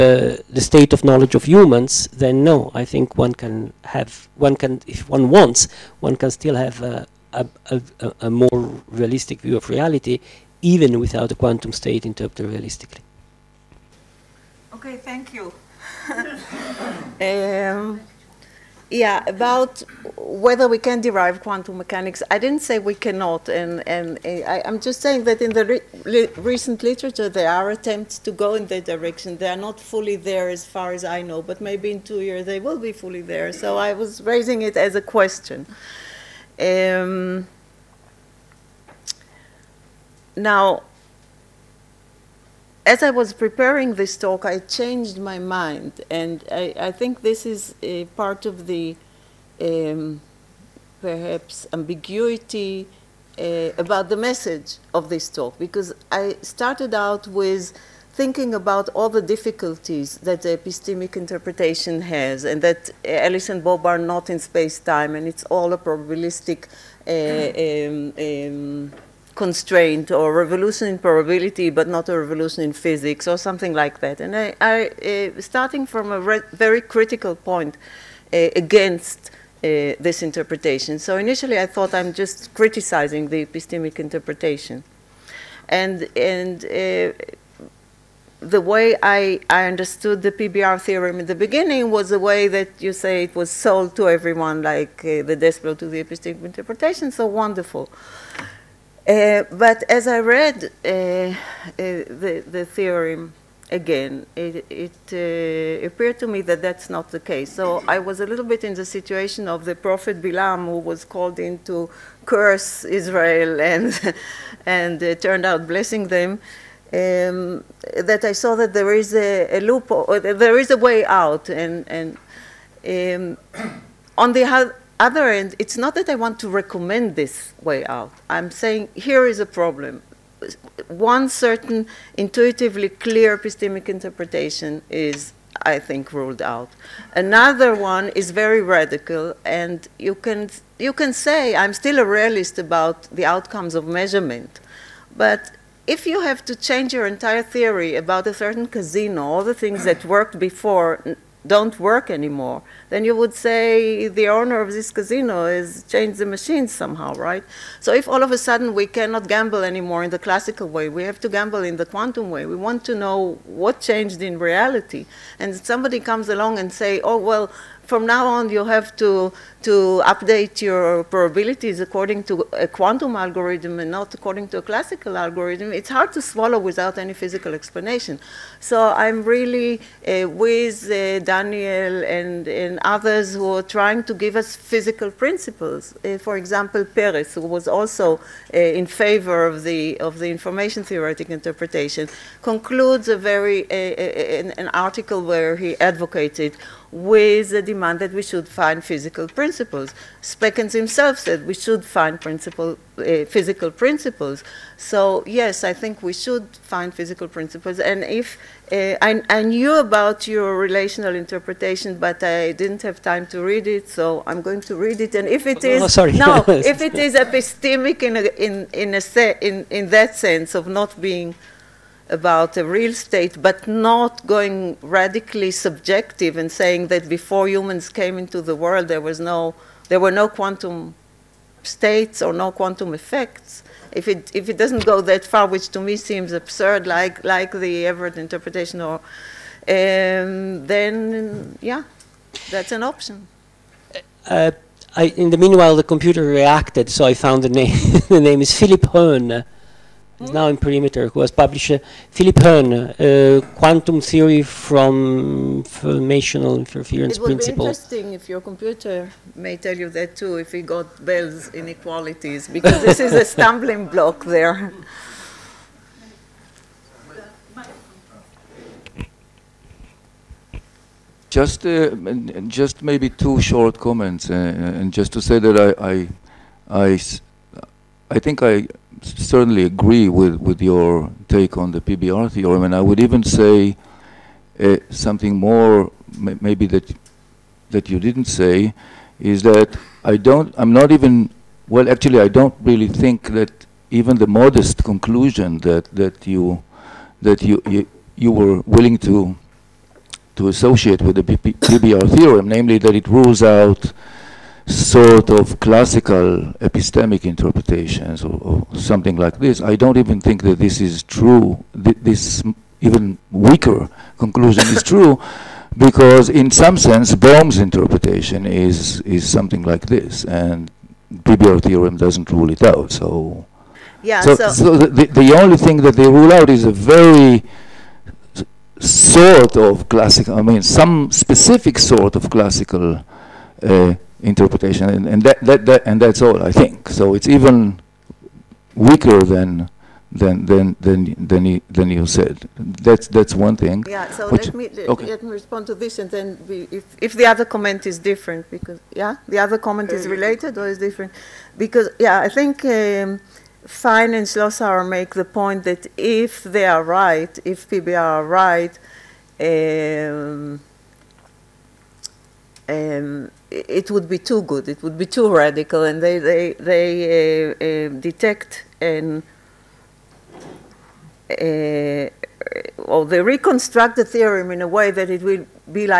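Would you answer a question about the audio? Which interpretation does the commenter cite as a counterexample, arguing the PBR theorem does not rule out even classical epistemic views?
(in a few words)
Bohm's interpretation.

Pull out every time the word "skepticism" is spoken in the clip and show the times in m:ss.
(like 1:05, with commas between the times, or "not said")
not said.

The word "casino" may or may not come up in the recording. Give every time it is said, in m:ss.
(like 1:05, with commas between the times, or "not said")
2:28, 2:34.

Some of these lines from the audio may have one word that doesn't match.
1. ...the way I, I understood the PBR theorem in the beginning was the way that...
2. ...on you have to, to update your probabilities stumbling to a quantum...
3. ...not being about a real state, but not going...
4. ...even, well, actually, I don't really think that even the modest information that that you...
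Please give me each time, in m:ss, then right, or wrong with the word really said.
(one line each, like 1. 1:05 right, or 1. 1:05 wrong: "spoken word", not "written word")
1. 1:28 right
2. 2:48 wrong: "according", not "stumbling"
3. 3:40 right
4. 4:50 wrong: "conclusion", not "information".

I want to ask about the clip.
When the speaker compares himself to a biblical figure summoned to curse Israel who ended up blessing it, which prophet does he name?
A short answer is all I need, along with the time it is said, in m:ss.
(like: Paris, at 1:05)
Bilam, at 1:49.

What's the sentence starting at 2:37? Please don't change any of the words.
So if all of a sudden we cannot gamble anymore in the classical way, we have to gamble in the quantum way.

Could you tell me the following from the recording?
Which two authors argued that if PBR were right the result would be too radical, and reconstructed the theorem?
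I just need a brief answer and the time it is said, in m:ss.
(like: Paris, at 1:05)
Fine and Schlosshauer, at 5:53.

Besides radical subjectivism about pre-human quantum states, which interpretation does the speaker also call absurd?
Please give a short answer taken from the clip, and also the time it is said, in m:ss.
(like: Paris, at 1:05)
Everett interpretation, at 3:57.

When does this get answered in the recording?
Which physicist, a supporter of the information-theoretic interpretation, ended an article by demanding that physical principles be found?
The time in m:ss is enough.
3:06.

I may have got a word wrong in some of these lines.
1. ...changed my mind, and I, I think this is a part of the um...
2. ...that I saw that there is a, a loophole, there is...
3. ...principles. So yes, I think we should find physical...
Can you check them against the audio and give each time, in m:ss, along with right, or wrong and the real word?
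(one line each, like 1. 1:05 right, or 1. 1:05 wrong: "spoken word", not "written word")
1. 0:44 right
2. 1:58 right
3. 3:23 right.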